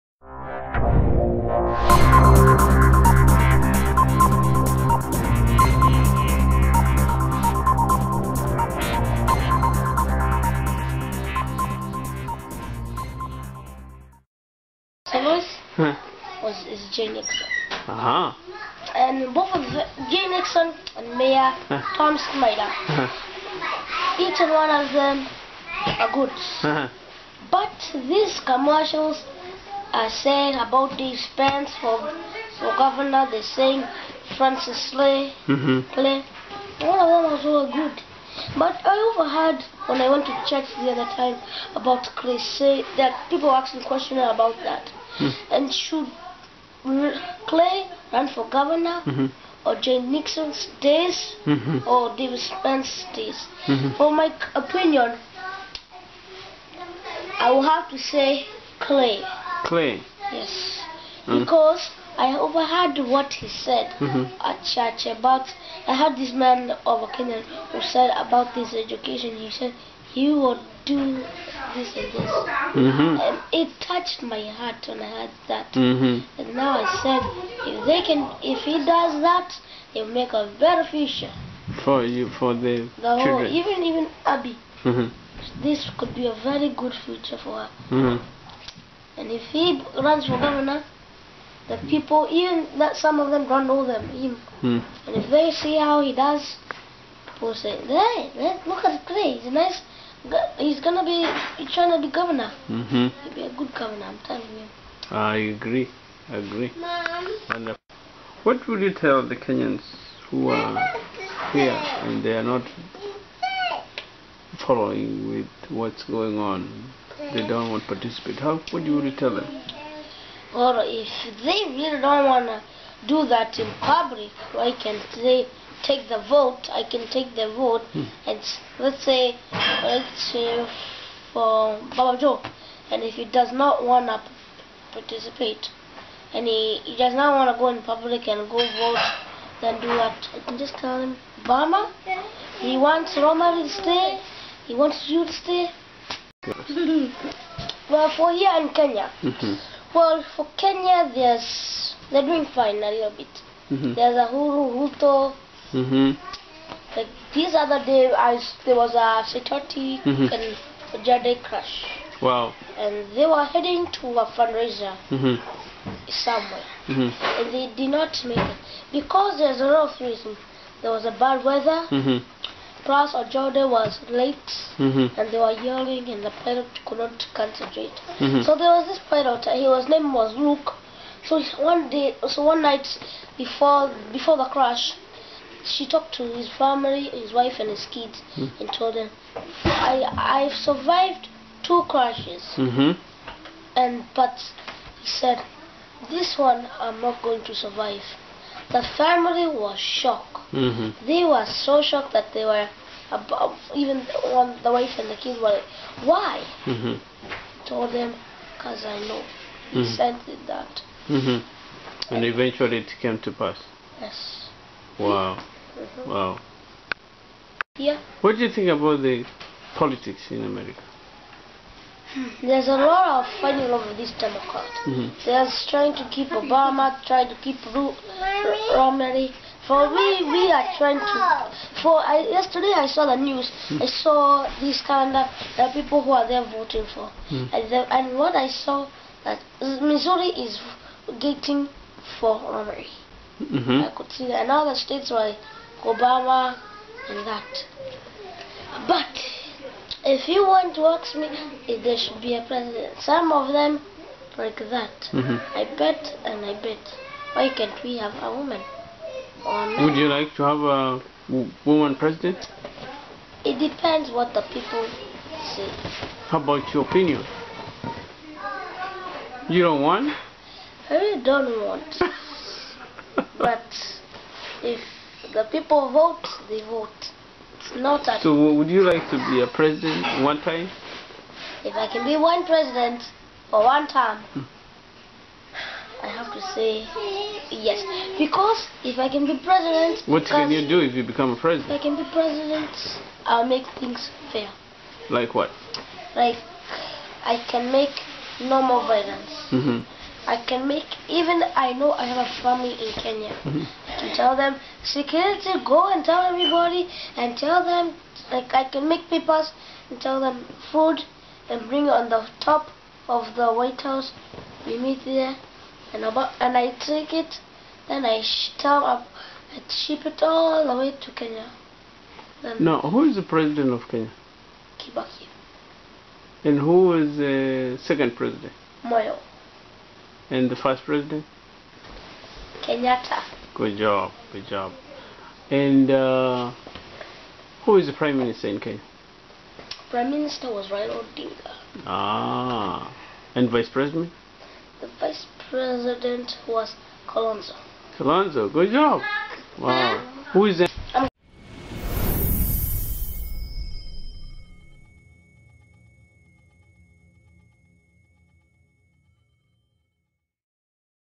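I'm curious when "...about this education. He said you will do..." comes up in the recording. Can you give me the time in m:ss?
1:08.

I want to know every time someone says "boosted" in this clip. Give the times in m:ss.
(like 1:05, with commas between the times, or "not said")
not said.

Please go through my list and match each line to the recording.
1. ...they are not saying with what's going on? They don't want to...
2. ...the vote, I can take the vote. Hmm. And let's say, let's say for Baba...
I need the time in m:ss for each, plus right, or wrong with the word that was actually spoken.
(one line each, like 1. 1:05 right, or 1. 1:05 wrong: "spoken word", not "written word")
1. 1:52 wrong: "following", not "saying"
2. 2:06 right.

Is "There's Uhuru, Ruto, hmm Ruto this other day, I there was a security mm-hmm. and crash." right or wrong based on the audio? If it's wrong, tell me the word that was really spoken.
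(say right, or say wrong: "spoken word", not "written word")
wrong: "Like", not "Ruto".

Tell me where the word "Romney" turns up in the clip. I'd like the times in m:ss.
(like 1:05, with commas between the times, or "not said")
3:48, 4:02.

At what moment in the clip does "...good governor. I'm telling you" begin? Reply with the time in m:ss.
1:43.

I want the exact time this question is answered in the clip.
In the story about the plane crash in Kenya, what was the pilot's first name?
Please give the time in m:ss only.
2:59.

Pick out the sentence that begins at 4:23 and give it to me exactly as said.
It depends what the people say.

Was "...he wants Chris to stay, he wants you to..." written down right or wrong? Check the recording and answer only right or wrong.
wrong.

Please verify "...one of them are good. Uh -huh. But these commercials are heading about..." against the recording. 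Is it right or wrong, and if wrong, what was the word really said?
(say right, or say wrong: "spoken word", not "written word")
wrong: "saying", not "heading".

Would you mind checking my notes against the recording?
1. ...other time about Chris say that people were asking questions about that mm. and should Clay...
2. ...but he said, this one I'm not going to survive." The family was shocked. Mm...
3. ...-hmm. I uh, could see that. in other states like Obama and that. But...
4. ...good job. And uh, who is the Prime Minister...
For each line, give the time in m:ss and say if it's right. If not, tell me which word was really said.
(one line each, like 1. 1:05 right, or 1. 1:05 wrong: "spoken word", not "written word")
1. 0:40 right
2. 3:14 right
3. 4:03 right
4. 5:34 right.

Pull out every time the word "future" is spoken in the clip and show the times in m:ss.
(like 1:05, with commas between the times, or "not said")
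1:20, 1:27.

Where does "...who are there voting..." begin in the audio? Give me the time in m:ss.
3:56.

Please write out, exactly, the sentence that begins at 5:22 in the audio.
Then now, who is the president of Kenya?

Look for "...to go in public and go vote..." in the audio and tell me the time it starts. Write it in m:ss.
2:17.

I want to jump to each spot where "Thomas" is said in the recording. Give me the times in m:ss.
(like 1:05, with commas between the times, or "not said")
0:15.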